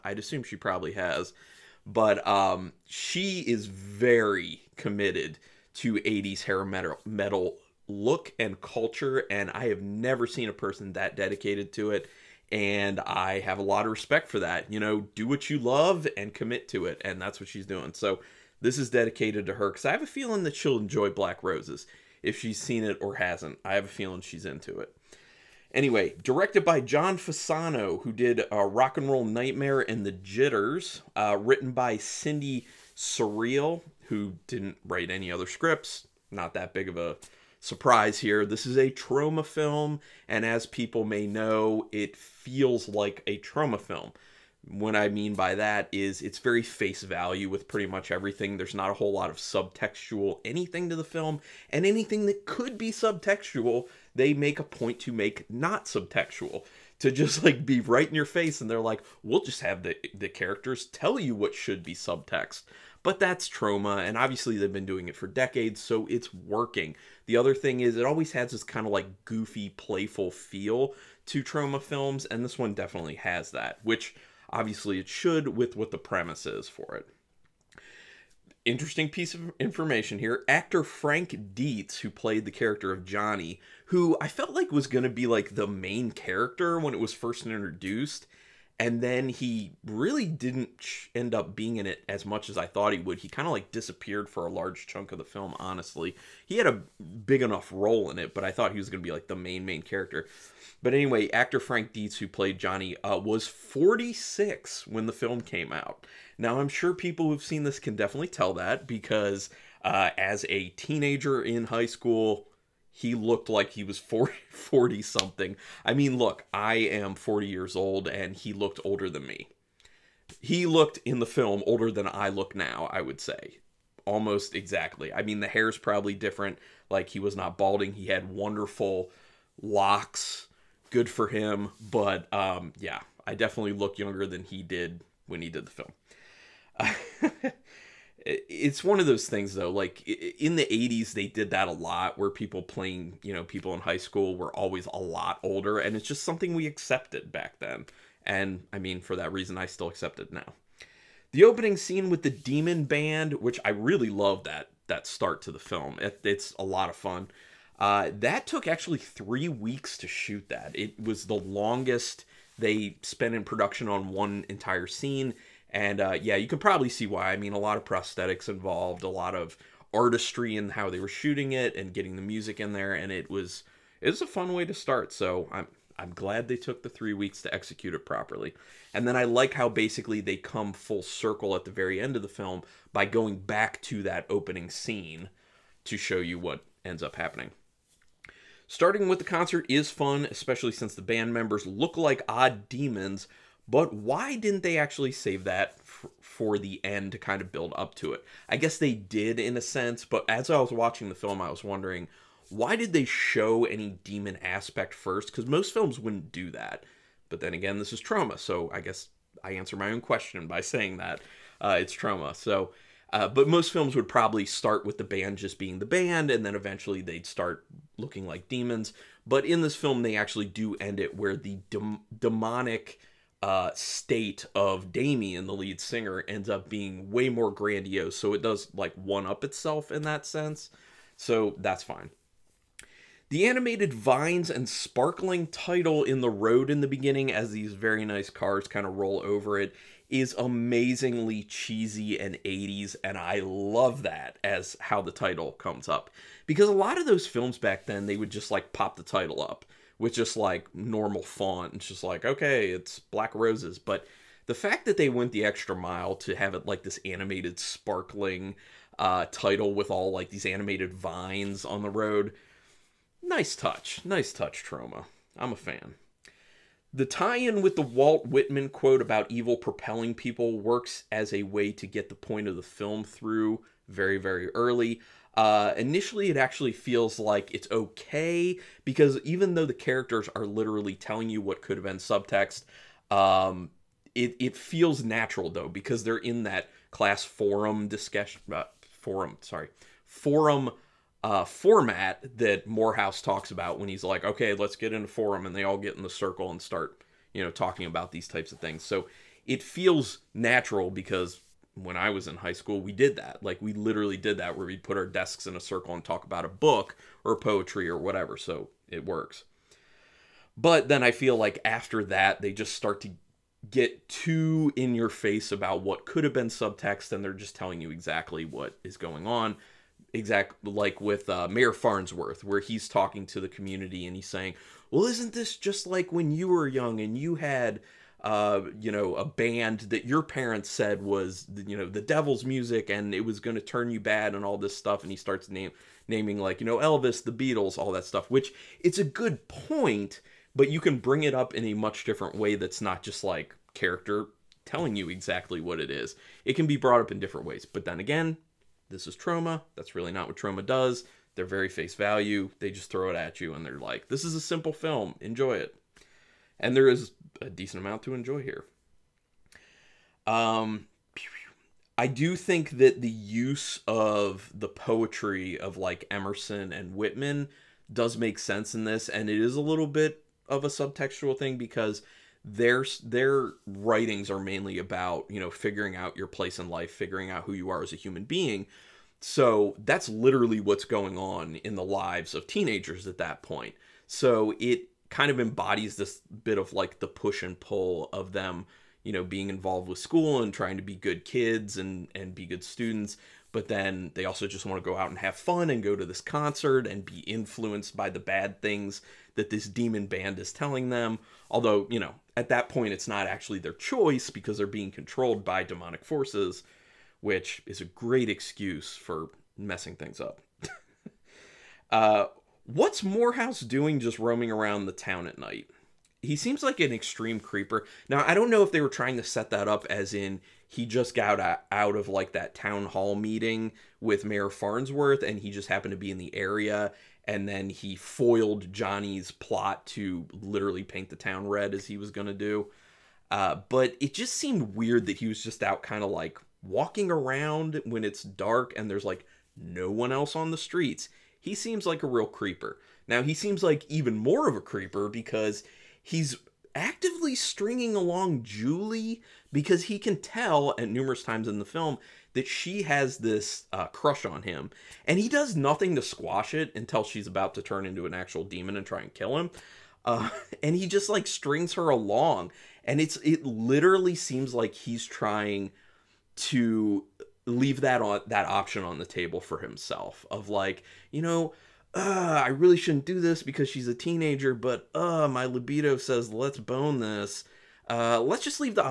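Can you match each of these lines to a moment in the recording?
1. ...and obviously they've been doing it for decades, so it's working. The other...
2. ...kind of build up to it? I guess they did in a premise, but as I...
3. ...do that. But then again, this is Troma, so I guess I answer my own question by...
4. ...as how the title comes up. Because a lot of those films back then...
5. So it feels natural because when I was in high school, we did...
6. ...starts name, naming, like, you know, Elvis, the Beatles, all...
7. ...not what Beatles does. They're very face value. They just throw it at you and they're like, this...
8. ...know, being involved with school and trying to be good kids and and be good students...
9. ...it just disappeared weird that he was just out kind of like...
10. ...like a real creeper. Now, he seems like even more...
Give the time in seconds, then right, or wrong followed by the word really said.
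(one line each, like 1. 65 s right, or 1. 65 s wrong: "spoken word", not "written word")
1. 64 s right
2. 197 s wrong: "sense", not "premise"
3. 206 s right
4. 244 s right
5. 298 s right
6. 335 s right
7. 350 s wrong: "Troma", not "Beatles"
8. 389 s right
9. 434 s wrong: "seemed", not "disappeared"
10. 441 s right.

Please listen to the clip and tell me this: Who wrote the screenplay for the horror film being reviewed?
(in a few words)
Cindy Cirile.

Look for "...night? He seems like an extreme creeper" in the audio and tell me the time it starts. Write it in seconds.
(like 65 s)
415 s.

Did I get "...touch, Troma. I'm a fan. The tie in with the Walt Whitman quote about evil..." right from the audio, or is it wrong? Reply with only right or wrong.
right.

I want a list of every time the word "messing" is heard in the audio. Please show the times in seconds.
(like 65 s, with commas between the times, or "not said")
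409 s.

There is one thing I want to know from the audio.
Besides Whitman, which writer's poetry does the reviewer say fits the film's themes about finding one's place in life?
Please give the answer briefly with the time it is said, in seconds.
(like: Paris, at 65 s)
Emerson, at 366 s.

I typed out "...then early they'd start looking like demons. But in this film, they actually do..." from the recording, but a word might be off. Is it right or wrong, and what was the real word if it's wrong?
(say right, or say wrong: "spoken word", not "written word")
wrong: "eventually", not "early".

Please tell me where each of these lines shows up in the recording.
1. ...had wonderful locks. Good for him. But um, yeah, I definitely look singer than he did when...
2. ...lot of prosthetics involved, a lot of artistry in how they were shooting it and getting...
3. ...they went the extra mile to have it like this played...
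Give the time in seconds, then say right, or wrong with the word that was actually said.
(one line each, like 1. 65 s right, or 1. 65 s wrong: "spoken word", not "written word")
1. 128 s wrong: "younger", not "singer"
2. 167 s right
3. 254 s wrong: "animated", not "played".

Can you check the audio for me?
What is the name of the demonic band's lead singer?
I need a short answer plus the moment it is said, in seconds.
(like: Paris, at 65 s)
Damien, at 224 s.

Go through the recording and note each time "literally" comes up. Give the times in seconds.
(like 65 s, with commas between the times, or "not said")
280 s, 303 s, 380 s, 430 s, 463 s.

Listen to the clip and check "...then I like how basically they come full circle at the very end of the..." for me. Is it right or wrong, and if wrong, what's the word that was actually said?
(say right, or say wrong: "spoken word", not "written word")
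right.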